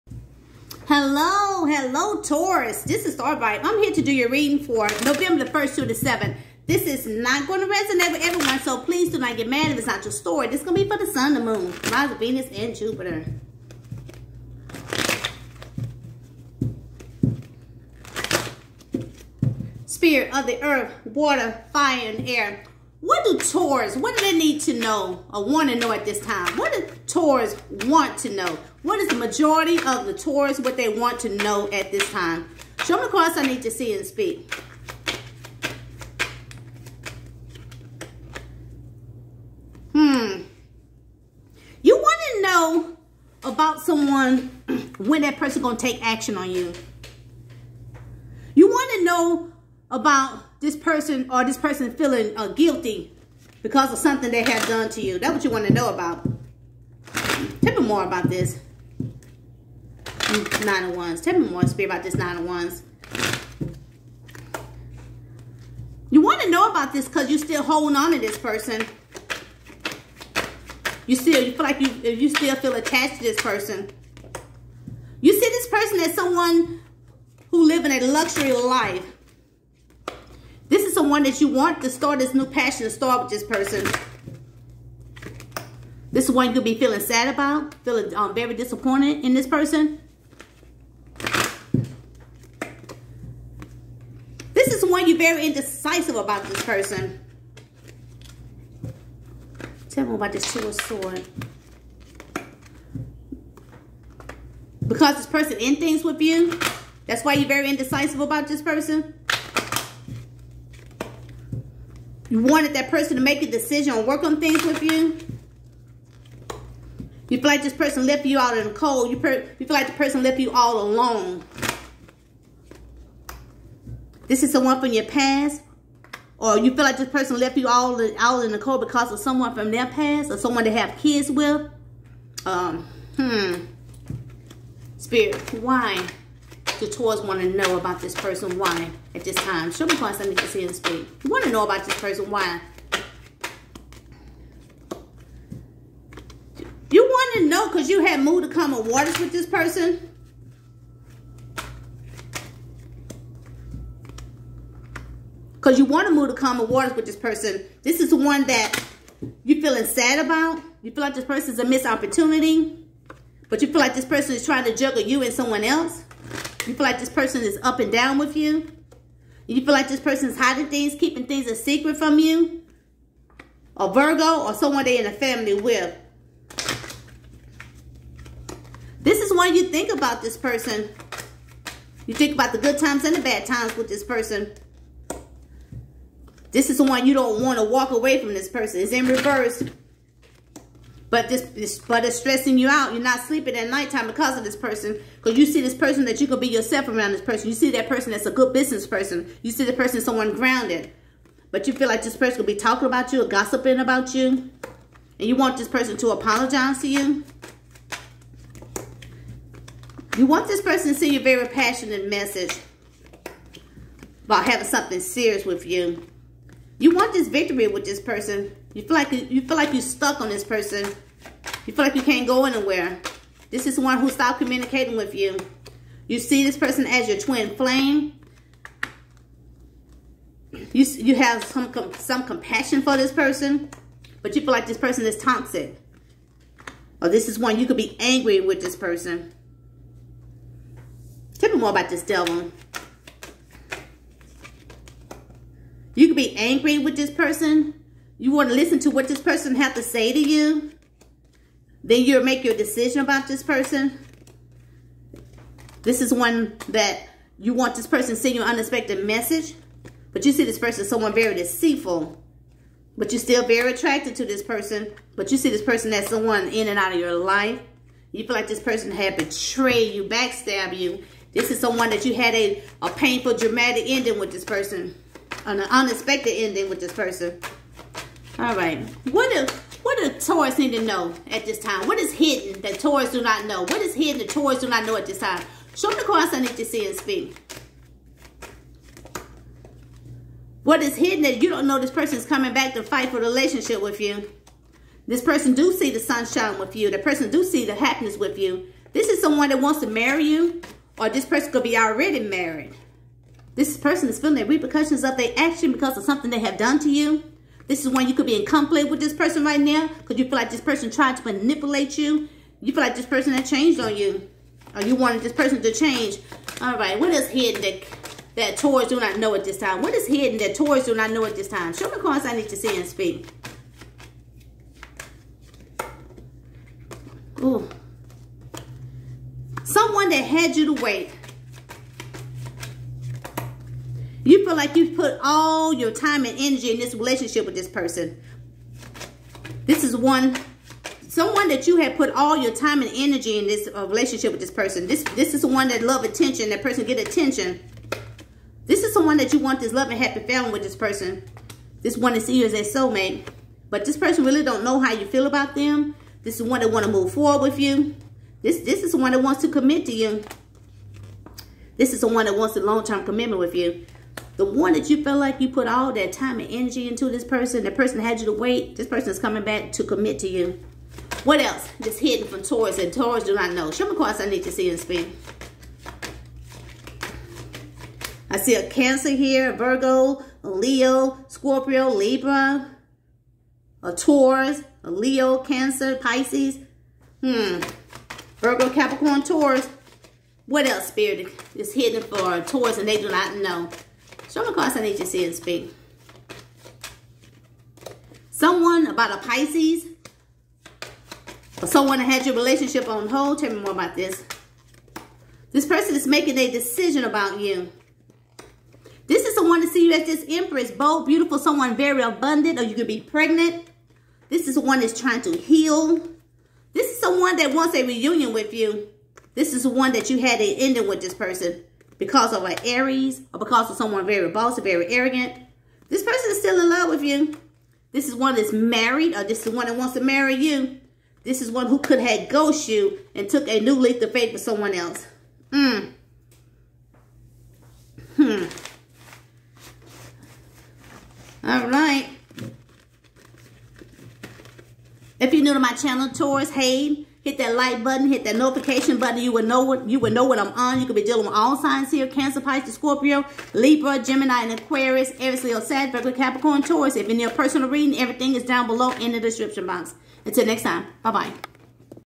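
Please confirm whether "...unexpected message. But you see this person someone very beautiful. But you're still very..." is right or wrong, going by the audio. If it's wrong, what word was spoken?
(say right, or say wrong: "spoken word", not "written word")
wrong: "deceitful", not "beautiful".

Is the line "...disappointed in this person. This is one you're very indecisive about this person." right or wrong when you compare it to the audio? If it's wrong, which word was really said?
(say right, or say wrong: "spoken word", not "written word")
right.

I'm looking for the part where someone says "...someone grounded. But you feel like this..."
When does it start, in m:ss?
3:19.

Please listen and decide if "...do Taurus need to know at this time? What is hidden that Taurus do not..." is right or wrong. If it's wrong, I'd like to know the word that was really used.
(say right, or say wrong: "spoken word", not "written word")
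right.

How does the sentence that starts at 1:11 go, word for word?
You still you feel like you you still feel attached to this person.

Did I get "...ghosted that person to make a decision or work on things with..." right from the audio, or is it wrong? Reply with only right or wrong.
wrong.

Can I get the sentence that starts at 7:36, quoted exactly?
If you need a personal reading, everything is down below in the description box.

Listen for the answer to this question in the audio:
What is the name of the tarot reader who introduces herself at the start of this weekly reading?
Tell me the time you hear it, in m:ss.
0:03.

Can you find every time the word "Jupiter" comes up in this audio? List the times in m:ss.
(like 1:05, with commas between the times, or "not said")
0:12.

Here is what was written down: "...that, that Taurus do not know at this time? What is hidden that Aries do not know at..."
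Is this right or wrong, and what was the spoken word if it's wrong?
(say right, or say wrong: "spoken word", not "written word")
wrong: "Taurus", not "Aries".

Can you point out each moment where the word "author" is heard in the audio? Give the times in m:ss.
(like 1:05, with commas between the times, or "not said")
not said.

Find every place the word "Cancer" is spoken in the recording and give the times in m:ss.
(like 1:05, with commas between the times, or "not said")
6:18, 6:25, 7:32.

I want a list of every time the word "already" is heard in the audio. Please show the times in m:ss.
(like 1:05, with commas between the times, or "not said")
5:01.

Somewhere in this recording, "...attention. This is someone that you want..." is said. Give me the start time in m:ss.
5:46.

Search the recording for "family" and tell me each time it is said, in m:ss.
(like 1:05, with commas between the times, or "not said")
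2:55, 5:50.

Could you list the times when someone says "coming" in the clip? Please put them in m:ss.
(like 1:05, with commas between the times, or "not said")
4:52, 6:09.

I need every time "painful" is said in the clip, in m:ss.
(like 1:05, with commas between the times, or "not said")
4:32.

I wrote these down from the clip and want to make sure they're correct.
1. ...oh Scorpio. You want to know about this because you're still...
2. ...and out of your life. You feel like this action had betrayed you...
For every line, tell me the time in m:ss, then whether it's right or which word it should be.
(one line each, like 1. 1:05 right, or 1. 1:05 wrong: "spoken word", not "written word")
1. 1:02 wrong: "Wands", not "Scorpio"
2. 4:26 wrong: "person", not "action".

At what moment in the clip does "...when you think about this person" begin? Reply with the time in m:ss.
2:59.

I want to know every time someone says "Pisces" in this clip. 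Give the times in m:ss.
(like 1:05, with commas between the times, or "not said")
6:25, 6:39, 7:32.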